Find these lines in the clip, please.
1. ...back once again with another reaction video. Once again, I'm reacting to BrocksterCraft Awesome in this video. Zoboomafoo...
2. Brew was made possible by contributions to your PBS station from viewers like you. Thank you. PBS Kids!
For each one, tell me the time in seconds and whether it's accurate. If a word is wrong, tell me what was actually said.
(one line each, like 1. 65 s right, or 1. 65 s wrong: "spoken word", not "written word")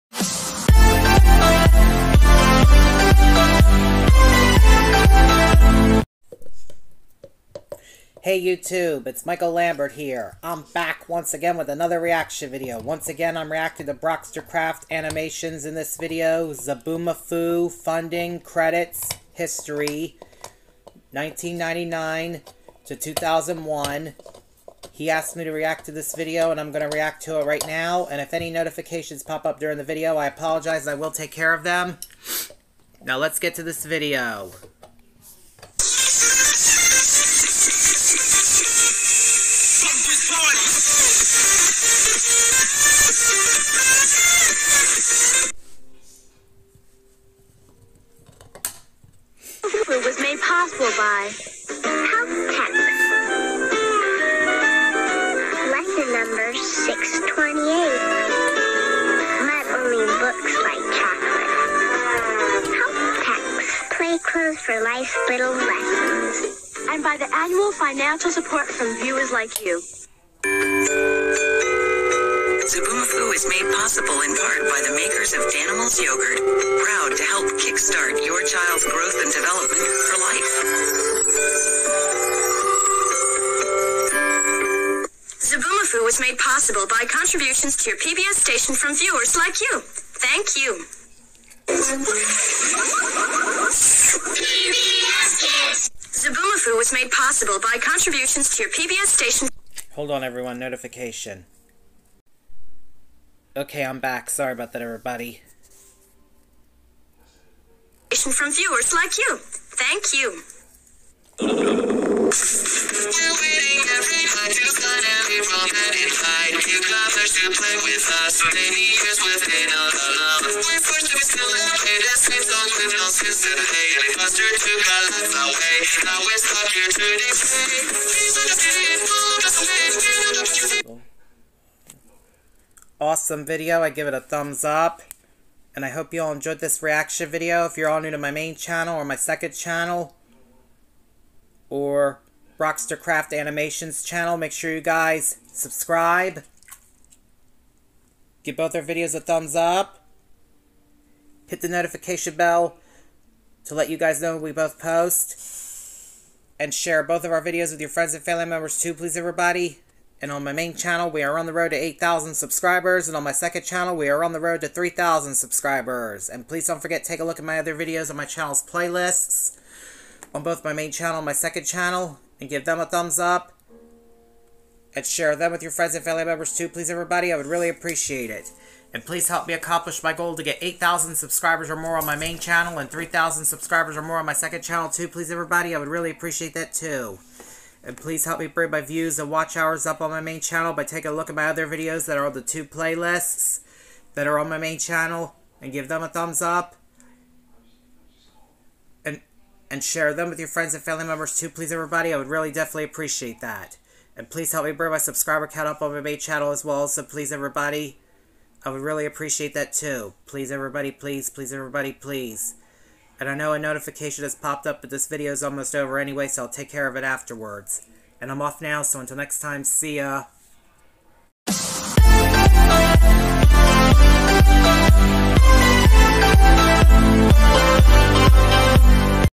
1. 10 s wrong: "Animationz", not "Awesome"
2. 86 s right.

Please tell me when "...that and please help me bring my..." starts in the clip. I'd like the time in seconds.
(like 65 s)
203 s.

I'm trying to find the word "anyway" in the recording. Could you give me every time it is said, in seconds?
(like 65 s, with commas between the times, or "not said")
215 s.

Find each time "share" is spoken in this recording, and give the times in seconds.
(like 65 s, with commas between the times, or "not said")
156 s, 175 s, 199 s.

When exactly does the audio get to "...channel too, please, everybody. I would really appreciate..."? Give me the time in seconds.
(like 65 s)
184 s.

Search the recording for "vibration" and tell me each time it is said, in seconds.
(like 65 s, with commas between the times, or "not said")
not said.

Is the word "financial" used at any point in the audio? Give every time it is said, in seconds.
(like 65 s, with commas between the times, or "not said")
67 s.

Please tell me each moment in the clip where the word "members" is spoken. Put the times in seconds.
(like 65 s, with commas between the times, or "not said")
158 s, 176 s, 201 s.